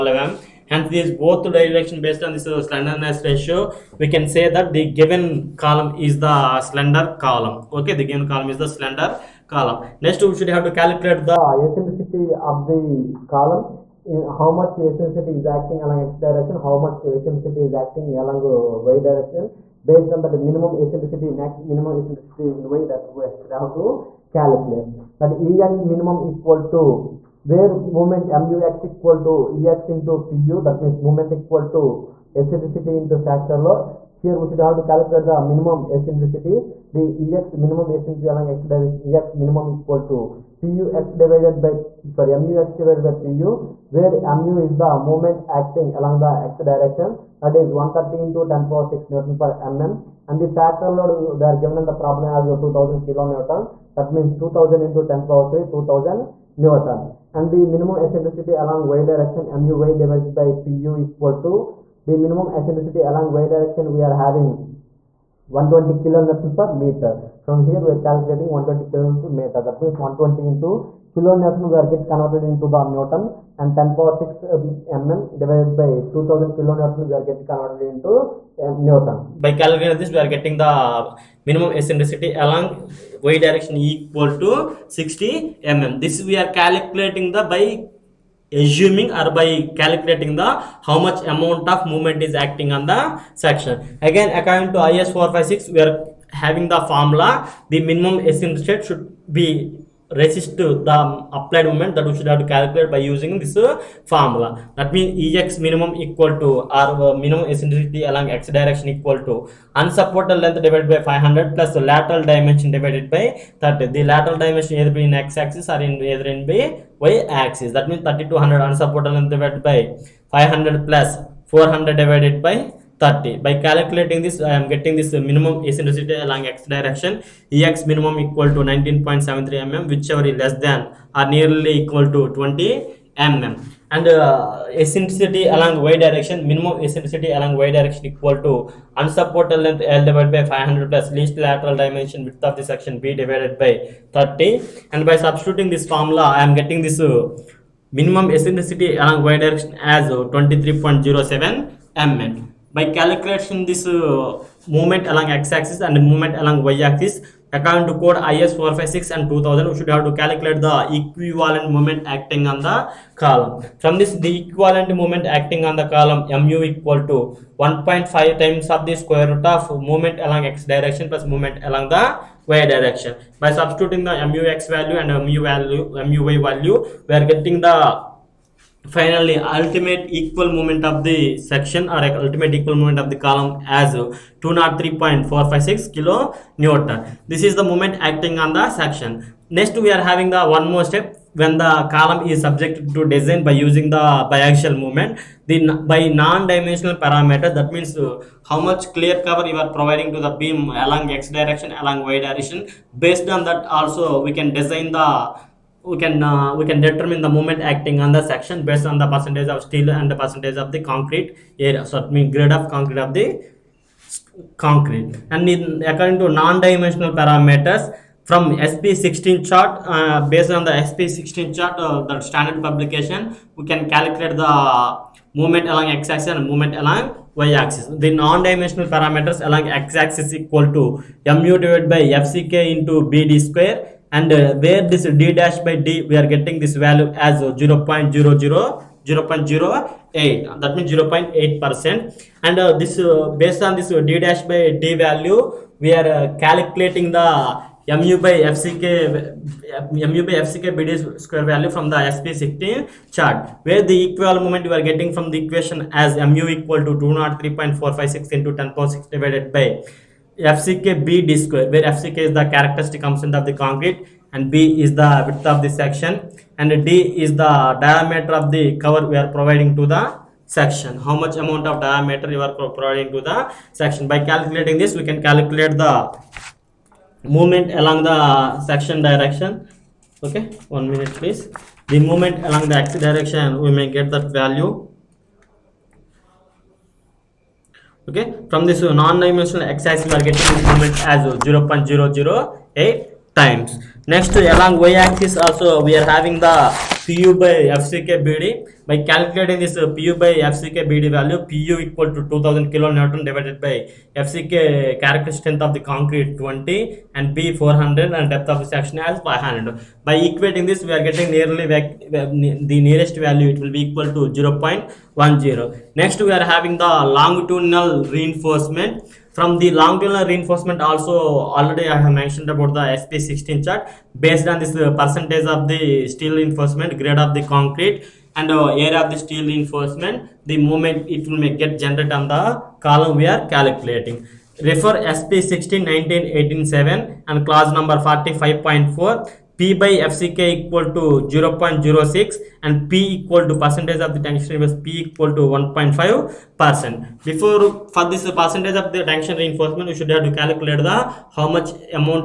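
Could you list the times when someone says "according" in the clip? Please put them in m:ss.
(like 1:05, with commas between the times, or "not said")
1:34, 2:37, 3:35.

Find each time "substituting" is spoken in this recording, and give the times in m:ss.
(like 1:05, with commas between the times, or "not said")
2:25, 2:53.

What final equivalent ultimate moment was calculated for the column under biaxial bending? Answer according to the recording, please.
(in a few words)
203.456 kN.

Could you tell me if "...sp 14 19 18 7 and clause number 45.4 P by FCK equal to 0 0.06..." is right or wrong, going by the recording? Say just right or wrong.
wrong.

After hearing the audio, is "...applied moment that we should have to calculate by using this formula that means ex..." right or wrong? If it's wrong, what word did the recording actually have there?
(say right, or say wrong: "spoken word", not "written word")
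right.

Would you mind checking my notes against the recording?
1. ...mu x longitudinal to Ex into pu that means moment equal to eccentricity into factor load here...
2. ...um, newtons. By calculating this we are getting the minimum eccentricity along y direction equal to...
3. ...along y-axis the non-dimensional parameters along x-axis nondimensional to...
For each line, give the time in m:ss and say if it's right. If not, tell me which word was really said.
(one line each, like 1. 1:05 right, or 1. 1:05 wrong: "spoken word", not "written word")
1. 0:28 wrong: "equal", not "longitudinal"
2. 1:18 right
3. 3:46 wrong: "equal", not "nondimensional".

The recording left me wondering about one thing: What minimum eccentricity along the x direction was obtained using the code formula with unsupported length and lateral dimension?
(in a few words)
19.73 mm.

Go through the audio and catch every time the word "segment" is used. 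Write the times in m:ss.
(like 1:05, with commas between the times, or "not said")
not said.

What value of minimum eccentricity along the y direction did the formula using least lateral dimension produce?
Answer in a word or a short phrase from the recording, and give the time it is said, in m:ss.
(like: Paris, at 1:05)
23.07 mm, at 2:30.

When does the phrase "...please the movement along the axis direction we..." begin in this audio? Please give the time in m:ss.
4:41.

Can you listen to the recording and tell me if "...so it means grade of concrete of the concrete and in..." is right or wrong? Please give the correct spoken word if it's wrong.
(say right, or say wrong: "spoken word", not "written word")
right.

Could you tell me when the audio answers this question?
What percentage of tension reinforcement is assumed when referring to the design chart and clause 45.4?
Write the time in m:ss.
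5:45.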